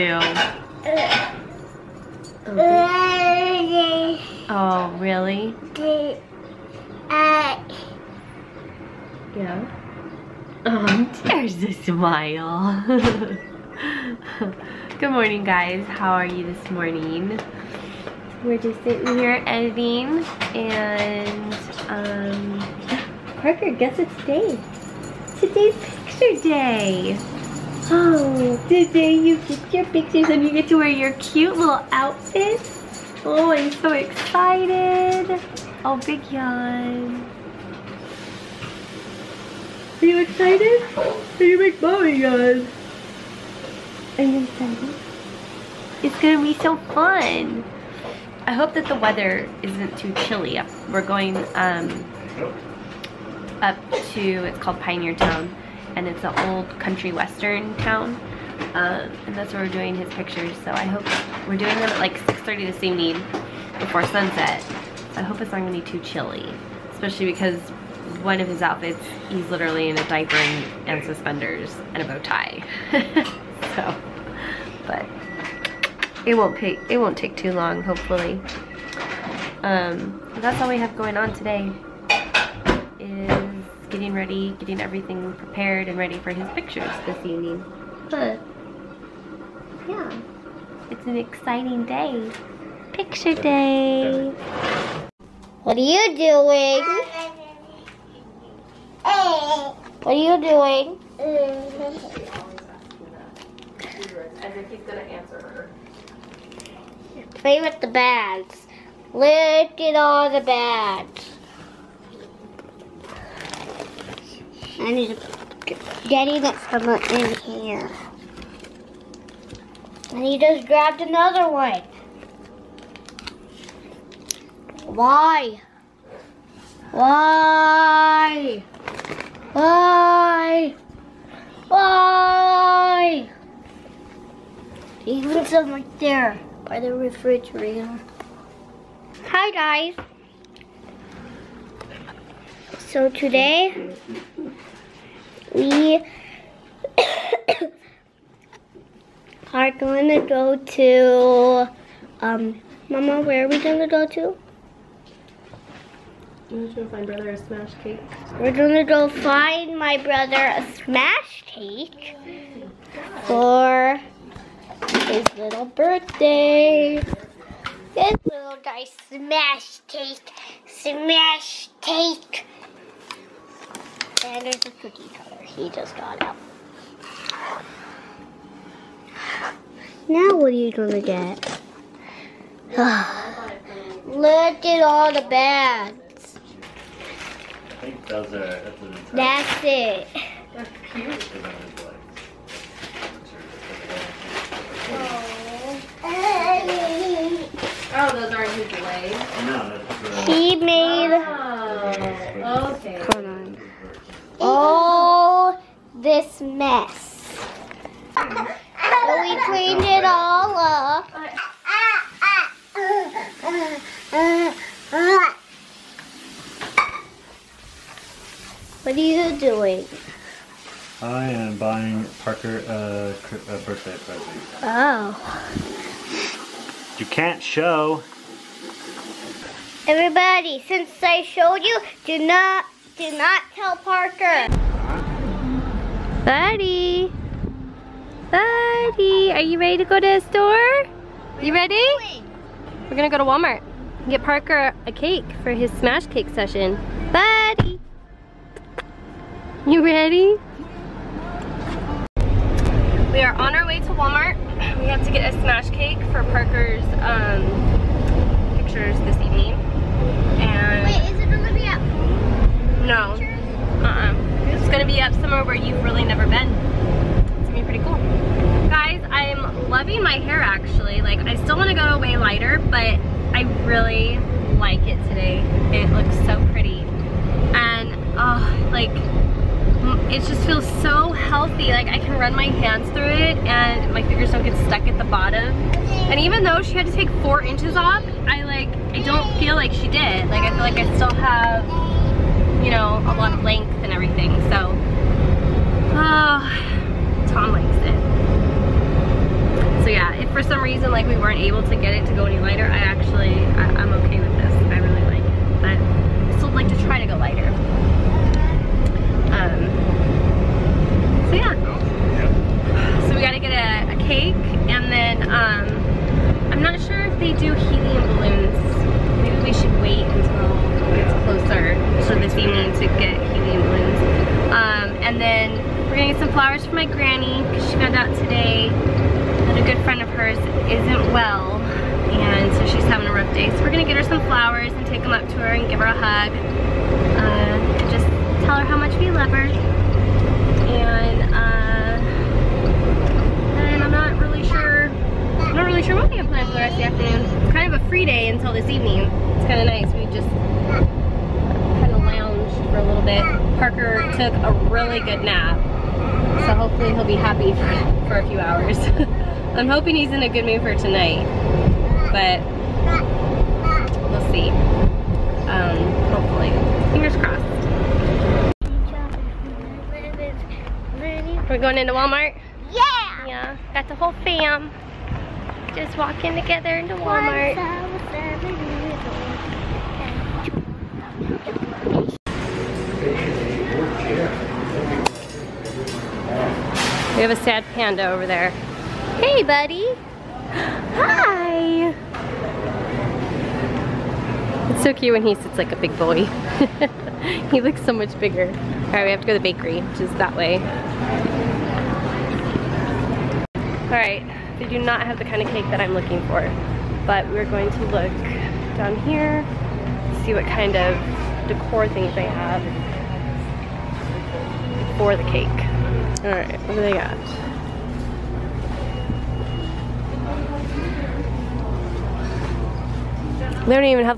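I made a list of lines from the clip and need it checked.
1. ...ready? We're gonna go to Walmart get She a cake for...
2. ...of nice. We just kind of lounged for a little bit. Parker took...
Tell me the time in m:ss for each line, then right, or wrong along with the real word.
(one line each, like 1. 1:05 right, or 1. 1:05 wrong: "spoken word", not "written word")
1. 4:01 wrong: "Parker", not "She"
2. 5:49 right.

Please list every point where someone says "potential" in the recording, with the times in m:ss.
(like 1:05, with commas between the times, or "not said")
not said.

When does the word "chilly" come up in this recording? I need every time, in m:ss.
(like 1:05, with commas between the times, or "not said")
0:50, 1:06.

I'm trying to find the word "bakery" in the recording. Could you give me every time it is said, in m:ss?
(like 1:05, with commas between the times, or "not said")
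6:39.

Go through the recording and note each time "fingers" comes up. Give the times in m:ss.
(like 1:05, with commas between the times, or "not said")
4:44, 6:06.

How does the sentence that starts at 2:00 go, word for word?
And he just grabbed another one.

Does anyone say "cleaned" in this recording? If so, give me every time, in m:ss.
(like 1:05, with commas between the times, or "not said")
3:29.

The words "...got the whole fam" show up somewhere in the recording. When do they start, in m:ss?
6:13.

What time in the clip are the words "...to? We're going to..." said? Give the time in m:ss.
2:34.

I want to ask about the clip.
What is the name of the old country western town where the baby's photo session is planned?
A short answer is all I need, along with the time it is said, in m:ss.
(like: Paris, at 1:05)
Pioneer Town, at 0:54.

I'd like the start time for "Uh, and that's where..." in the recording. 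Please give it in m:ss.
0:58.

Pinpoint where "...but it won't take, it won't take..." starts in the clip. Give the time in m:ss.
1:14.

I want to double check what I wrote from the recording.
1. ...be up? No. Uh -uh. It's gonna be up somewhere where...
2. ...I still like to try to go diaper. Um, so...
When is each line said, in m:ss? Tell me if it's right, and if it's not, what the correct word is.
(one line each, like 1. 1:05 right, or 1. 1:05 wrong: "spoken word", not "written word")
1. 4:21 right
2. 5:05 wrong: "lighter", not "diaper".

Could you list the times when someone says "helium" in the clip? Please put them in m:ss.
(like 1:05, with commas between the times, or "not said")
5:17, 5:23.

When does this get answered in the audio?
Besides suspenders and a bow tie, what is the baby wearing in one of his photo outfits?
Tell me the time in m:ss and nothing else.
1:09.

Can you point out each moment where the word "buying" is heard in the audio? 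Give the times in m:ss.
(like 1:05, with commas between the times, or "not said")
3:41.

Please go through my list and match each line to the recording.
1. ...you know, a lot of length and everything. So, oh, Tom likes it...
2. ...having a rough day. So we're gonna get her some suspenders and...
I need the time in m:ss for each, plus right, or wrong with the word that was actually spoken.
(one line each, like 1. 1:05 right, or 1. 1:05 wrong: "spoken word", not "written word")
1. 4:52 right
2. 5:32 wrong: "flowers", not "suspenders".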